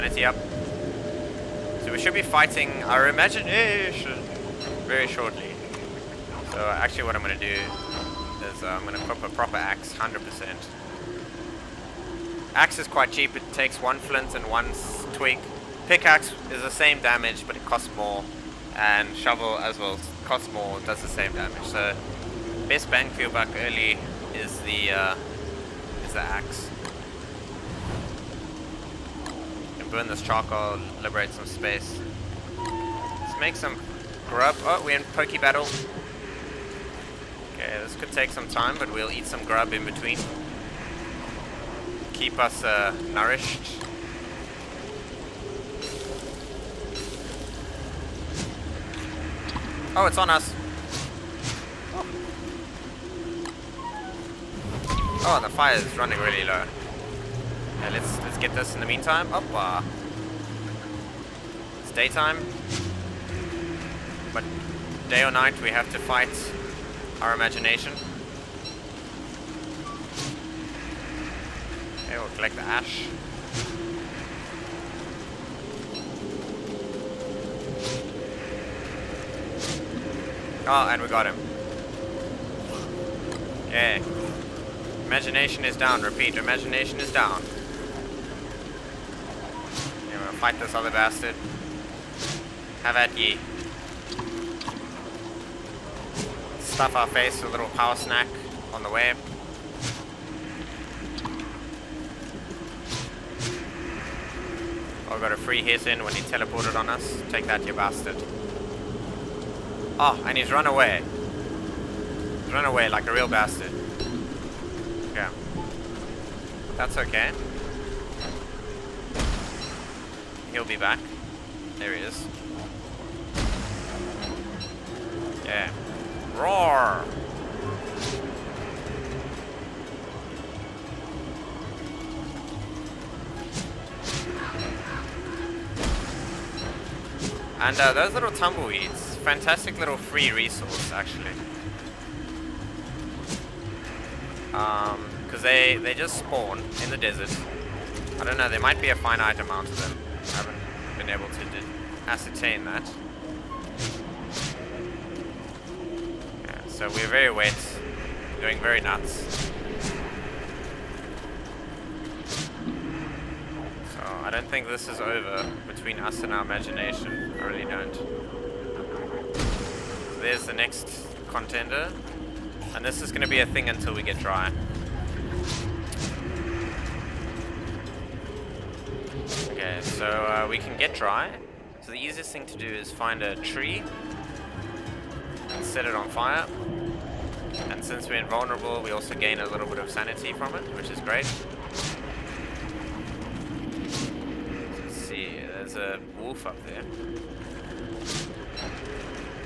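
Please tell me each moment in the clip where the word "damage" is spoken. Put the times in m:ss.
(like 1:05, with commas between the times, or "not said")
0:17, 0:21.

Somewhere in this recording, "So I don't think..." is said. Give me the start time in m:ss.
2:43.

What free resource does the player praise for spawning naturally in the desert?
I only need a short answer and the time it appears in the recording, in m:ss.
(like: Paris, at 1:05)
tumbleweeds, at 2:18.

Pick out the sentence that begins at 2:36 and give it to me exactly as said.
So we're very wet, doing very nuts.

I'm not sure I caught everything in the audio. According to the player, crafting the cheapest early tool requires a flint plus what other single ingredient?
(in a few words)
one twig.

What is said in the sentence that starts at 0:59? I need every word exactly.
Up, uh, it's daytime, but day or night we have to fight our imagination.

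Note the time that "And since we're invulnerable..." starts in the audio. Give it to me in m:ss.
3:07.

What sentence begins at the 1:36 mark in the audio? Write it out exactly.
stuff our face with a little power snack on the way.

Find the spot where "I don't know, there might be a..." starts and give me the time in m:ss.
2:28.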